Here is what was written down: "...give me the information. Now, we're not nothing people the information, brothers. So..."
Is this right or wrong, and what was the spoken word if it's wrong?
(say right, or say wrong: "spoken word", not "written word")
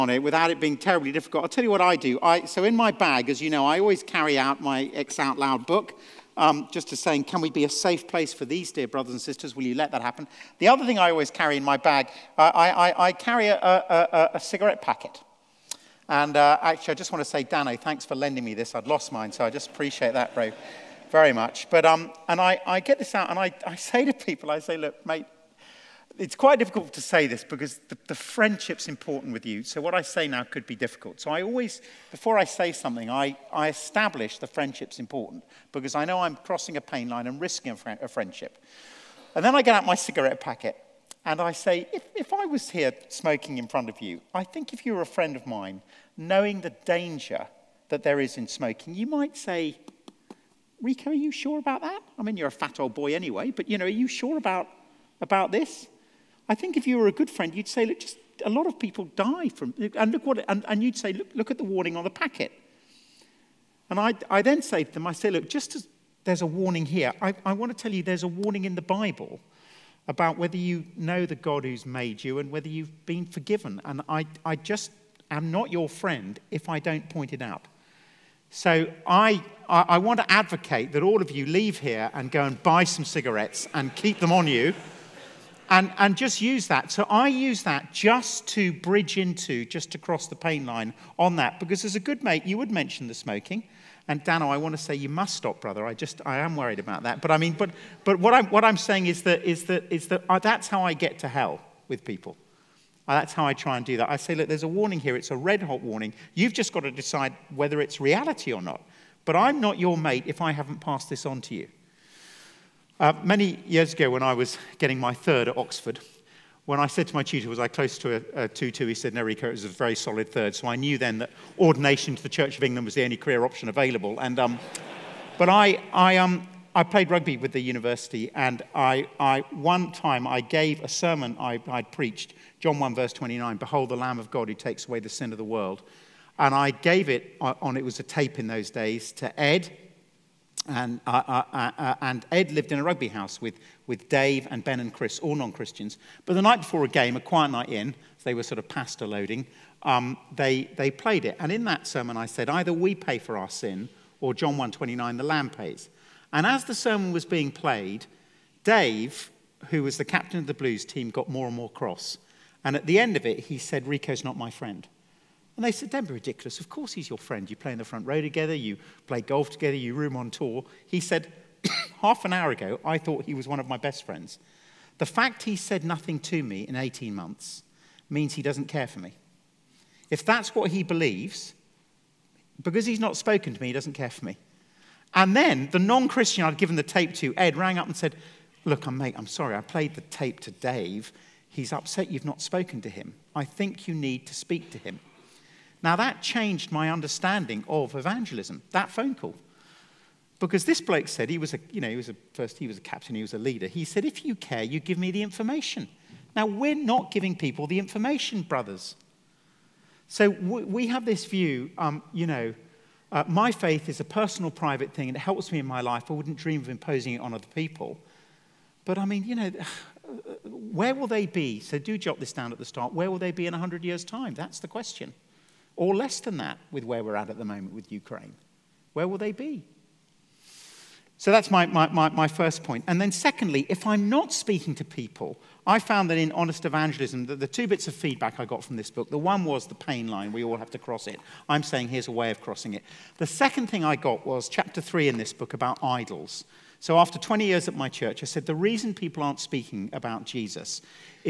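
wrong: "giving", not "nothing".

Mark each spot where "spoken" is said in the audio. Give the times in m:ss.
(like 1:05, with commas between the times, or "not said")
3:03, 3:12.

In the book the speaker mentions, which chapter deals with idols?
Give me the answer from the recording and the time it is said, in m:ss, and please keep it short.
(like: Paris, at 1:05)
Chapter 3, at 4:04.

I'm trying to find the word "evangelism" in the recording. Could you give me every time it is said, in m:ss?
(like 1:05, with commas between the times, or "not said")
3:17, 3:56.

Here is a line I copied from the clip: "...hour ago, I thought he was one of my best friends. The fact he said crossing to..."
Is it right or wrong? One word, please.
wrong.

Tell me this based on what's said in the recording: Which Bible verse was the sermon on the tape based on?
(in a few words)
John 1:29.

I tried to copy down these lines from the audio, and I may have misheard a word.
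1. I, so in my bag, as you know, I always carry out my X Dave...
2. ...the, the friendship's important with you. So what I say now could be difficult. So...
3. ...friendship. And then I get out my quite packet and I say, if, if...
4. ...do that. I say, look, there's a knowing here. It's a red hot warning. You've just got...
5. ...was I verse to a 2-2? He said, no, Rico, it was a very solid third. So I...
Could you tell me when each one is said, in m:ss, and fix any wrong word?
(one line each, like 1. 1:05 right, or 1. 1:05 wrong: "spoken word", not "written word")
1. 0:02 wrong: "Out", not "Dave"
2. 0:27 right
3. 0:38 wrong: "cigarette", not "quite"
4. 1:43 wrong: "warning", not "knowing"
5. 1:57 wrong: "close", not "verse".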